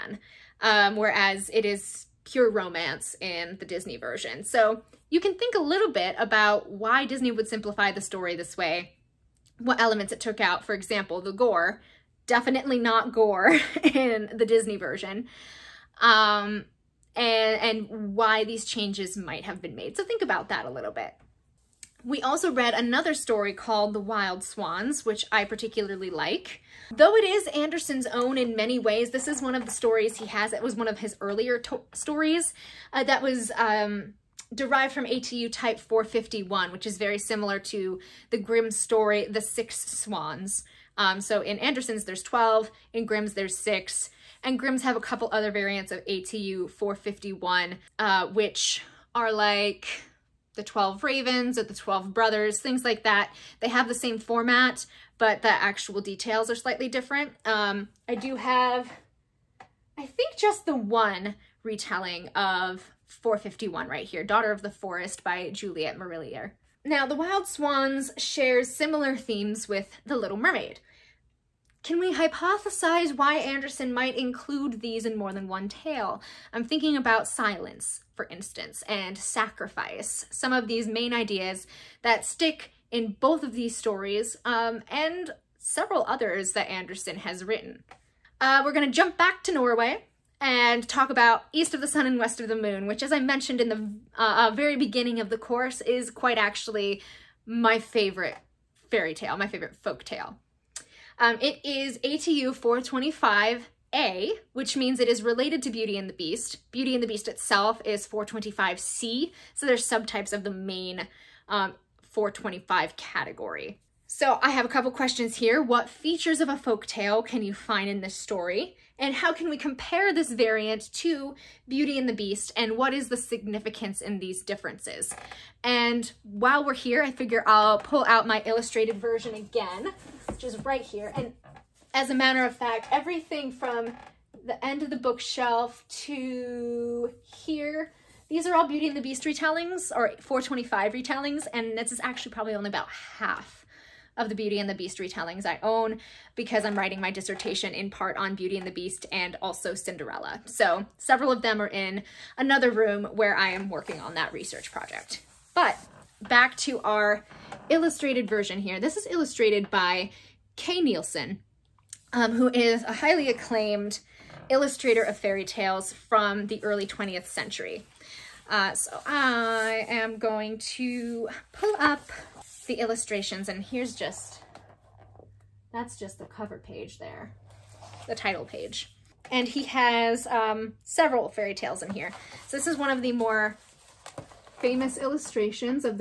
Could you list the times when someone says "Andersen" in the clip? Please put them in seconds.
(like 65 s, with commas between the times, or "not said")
27 s, 41 s, 73 s, 86 s.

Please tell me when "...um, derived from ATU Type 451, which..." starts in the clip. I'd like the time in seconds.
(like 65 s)
33 s.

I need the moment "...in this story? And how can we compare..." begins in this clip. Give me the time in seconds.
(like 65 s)
117 s.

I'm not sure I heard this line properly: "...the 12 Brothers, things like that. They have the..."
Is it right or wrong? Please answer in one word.
right.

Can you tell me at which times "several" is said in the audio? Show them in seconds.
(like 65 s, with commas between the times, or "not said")
85 s, 150 s, 180 s.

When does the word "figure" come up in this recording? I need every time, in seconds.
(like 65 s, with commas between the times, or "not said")
127 s.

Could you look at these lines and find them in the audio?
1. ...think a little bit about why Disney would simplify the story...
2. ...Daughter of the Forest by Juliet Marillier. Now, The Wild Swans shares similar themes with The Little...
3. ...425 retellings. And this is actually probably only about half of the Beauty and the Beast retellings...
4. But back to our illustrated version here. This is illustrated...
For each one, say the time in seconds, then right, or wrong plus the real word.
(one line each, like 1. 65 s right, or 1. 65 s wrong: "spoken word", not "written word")
1. 5 s right
2. 64 s right
3. 140 s right
4. 155 s right.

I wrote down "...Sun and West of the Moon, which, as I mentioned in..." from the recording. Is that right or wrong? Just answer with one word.
right.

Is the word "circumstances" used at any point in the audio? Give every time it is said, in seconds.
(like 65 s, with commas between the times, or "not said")
not said.